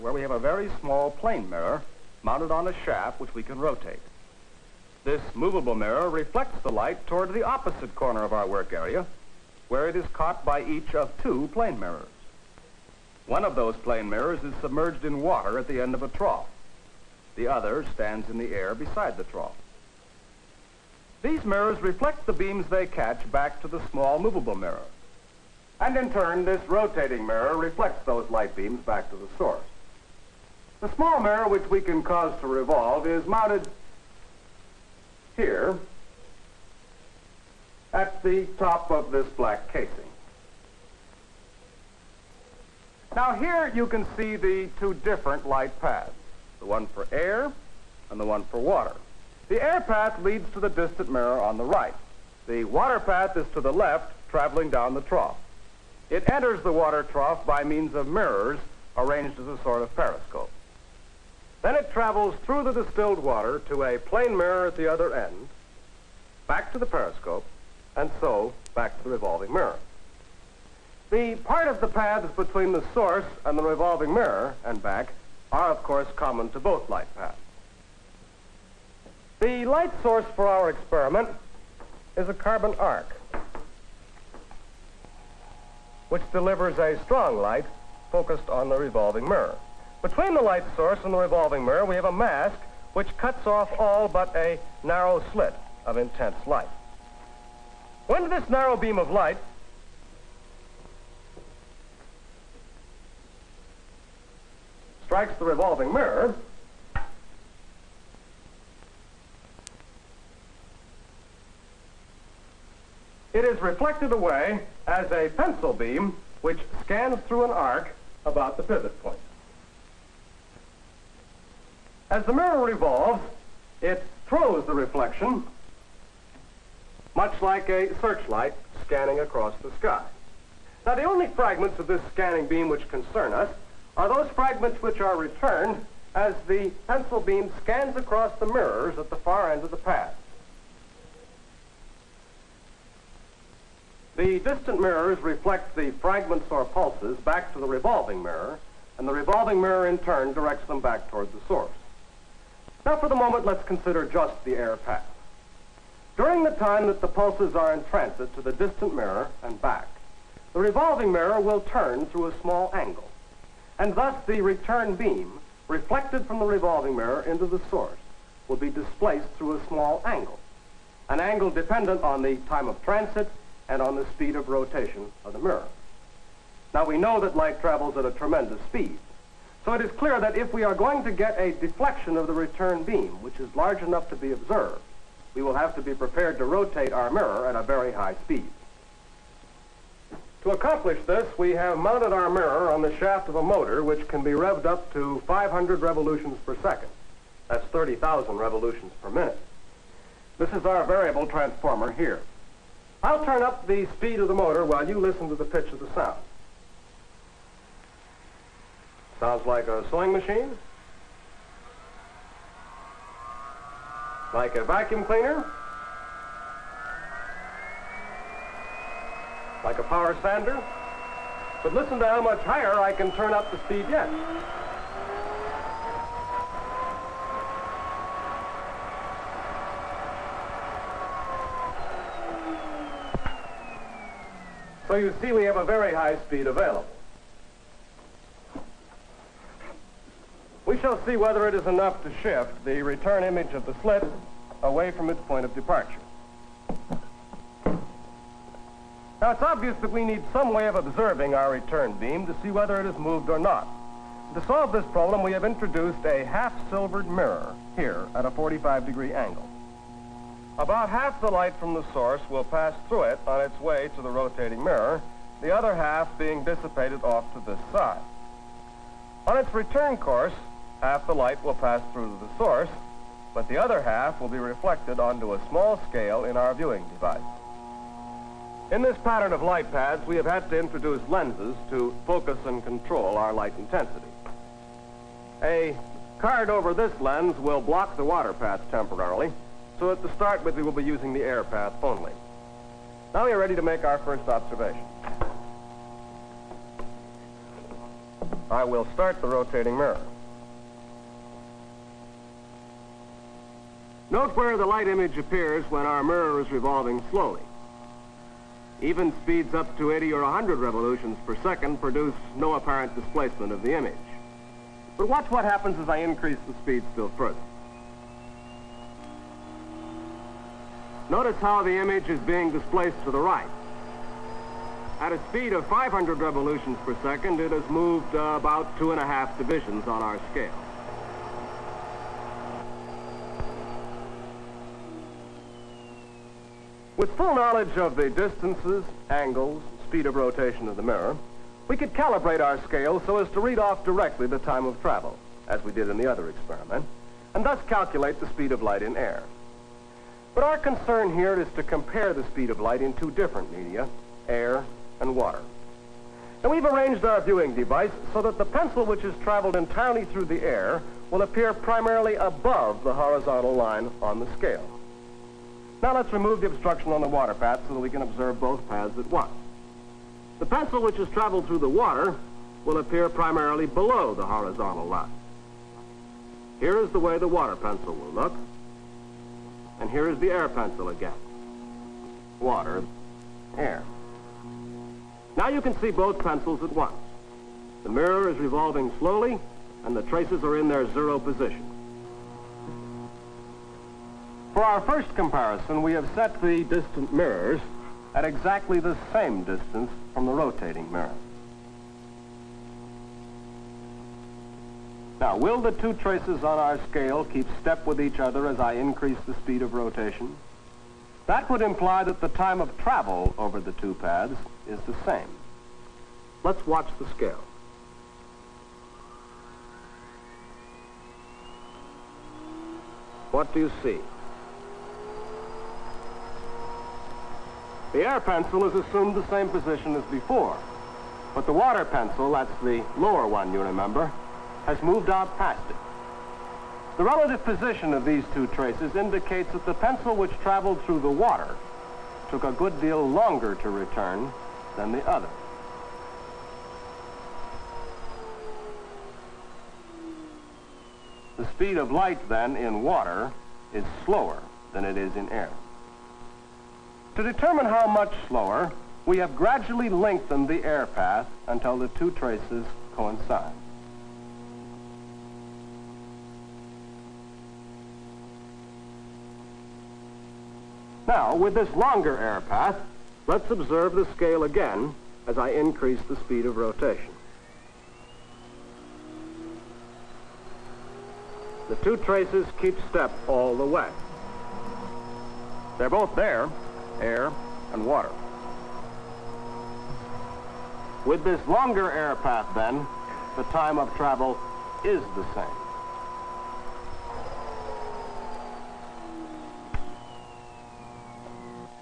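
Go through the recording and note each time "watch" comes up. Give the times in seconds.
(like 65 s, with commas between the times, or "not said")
315 s, 416 s.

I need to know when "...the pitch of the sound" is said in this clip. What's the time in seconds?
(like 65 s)
205 s.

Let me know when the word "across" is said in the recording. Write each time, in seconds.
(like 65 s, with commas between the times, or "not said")
129 s, 137 s.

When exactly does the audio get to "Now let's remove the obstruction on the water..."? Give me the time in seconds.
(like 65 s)
365 s.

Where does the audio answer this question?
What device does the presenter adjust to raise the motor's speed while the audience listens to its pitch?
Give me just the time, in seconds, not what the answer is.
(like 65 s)
200 s.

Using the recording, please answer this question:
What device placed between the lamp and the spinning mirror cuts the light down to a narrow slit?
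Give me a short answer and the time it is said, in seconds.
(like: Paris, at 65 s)
A mask, at 92 s.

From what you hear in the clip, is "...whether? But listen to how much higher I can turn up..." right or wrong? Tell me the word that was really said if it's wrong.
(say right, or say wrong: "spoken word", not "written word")
wrong: "sander", not "whether".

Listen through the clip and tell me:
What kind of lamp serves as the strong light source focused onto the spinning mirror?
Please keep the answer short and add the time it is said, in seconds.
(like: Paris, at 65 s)
Carbon arc, at 82 s.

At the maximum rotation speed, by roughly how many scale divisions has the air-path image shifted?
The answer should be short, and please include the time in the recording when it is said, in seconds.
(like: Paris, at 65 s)
2.5, at 328 s.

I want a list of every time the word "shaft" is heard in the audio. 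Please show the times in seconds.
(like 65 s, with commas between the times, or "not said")
2 s, 192 s.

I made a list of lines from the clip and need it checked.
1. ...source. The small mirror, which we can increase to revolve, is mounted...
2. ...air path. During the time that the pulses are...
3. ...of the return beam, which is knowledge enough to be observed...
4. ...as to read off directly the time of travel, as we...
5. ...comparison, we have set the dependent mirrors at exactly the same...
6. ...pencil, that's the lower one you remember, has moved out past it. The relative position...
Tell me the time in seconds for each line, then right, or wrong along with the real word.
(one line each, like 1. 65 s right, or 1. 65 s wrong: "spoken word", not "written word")
1. 29 s wrong: "cause", not "increase"
2. 154 s right
3. 182 s wrong: "large", not "knowledge"
4. 343 s right
5. 395 s wrong: "distant", not "dependent"
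6. 431 s right.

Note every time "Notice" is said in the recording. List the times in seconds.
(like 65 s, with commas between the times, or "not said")
321 s.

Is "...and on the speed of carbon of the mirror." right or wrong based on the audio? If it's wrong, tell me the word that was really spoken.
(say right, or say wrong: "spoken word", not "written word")
wrong: "rotation", not "carbon".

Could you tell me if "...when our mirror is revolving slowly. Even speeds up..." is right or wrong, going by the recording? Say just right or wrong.
right.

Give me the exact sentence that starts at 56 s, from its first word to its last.
It enters the water trough by means of mirrors arranged as a sort of periscope.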